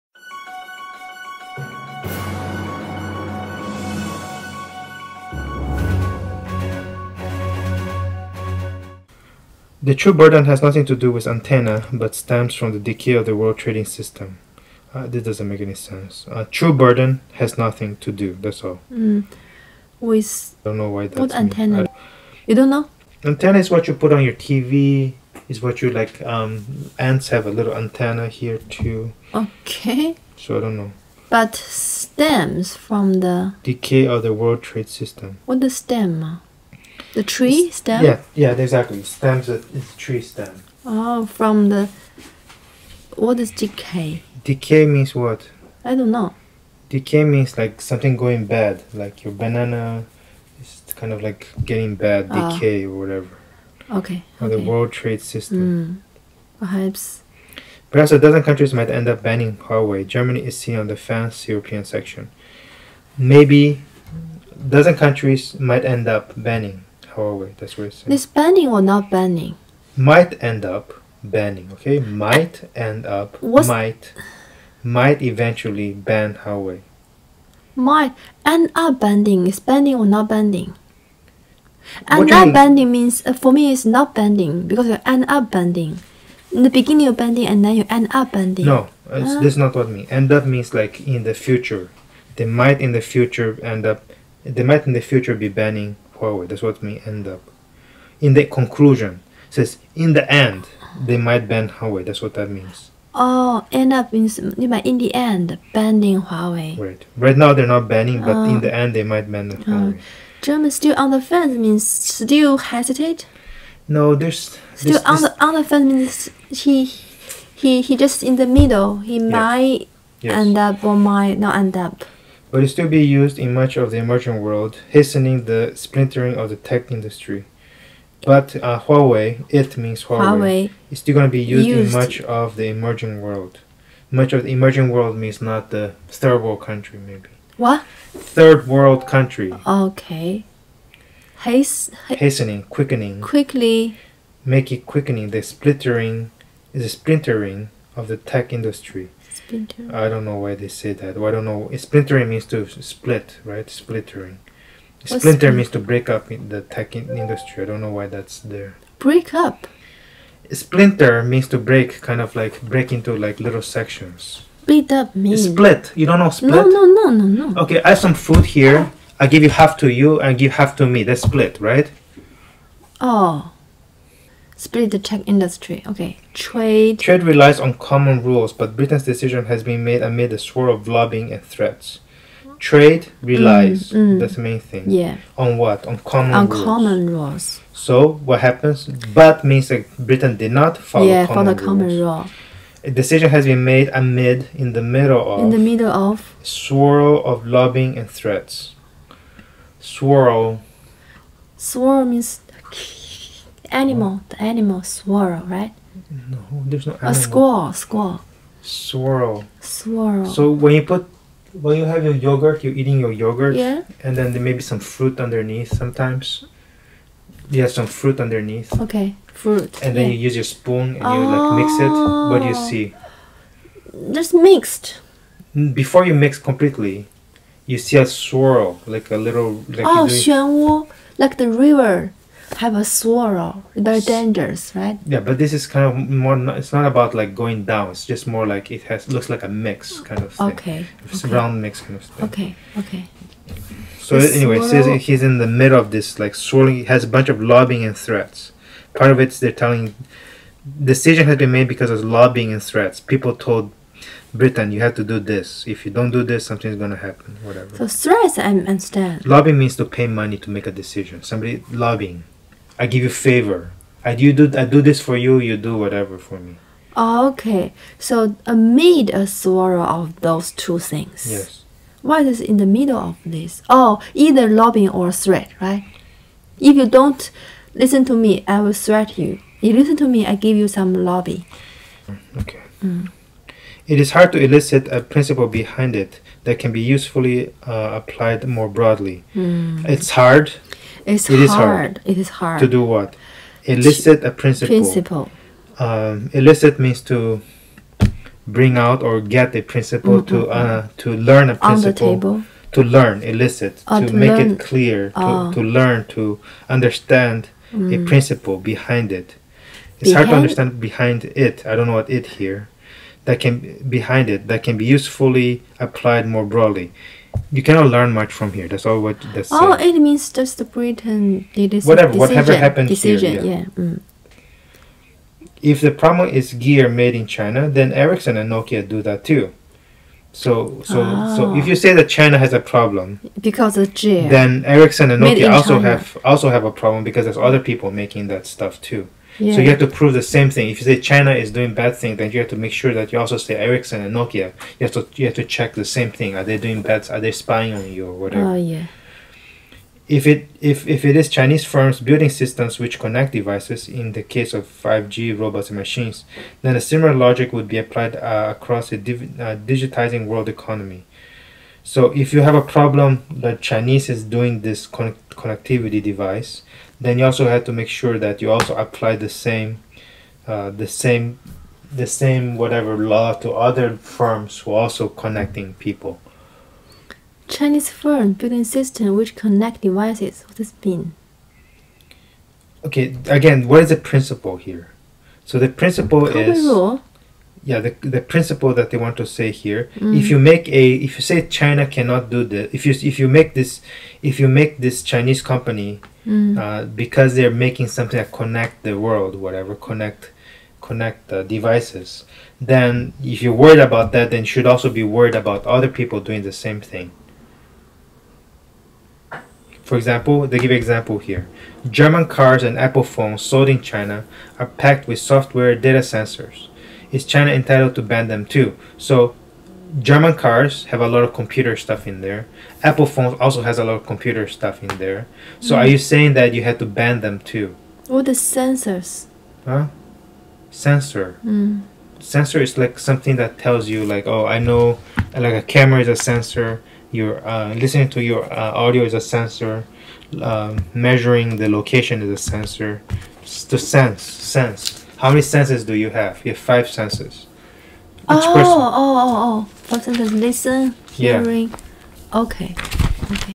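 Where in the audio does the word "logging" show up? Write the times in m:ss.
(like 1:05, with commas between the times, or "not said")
not said.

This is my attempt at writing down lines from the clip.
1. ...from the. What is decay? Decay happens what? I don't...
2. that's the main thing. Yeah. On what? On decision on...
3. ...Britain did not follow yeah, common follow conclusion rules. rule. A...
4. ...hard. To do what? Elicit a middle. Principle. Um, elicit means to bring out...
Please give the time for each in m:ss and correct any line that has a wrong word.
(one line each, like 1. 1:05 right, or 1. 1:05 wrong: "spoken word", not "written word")
1. 0:41 wrong: "means", not "happens"
2. 3:04 wrong: "common", not "decision"
3. 3:09 wrong: "common", not "conclusion"
4. 4:52 wrong: "principle", not "middle".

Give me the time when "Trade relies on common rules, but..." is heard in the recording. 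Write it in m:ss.
2:56.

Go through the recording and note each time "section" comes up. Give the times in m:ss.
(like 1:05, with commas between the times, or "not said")
1:01, 2:43.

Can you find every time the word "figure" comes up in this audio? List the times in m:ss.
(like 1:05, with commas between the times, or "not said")
not said.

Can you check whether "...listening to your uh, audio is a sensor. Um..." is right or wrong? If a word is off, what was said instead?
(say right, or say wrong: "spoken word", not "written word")
right.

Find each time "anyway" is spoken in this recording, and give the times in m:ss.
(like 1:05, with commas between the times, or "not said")
4:04.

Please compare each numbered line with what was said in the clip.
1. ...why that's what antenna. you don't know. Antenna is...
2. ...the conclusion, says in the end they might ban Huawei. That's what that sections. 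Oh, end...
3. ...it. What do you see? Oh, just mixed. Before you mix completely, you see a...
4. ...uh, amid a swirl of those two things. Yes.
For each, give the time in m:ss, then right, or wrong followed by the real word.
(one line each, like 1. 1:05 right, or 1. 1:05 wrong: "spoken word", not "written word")
1. 0:20 right
2. 1:38 wrong: "means", not "sections"
3. 3:41 right
4. 4:28 right.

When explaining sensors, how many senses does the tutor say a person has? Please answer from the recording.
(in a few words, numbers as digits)
5.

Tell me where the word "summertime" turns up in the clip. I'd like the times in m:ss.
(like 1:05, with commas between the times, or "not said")
not said.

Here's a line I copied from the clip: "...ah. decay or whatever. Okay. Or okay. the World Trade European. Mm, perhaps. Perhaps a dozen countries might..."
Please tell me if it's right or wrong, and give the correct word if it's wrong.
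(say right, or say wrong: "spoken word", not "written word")
wrong: "System", not "European".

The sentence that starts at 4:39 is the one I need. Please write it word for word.
You listen to me, I give you some lobby.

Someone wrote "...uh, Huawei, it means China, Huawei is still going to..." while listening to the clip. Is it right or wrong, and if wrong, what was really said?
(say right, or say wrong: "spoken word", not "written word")
wrong: "Huawei", not "China".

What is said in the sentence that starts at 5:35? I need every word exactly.
have also have a problem because there's other people making that stuff too.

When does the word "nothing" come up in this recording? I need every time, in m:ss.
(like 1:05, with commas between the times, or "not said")
0:10, 0:17.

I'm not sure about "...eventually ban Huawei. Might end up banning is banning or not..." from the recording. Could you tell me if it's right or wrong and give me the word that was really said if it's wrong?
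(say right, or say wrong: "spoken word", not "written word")
right.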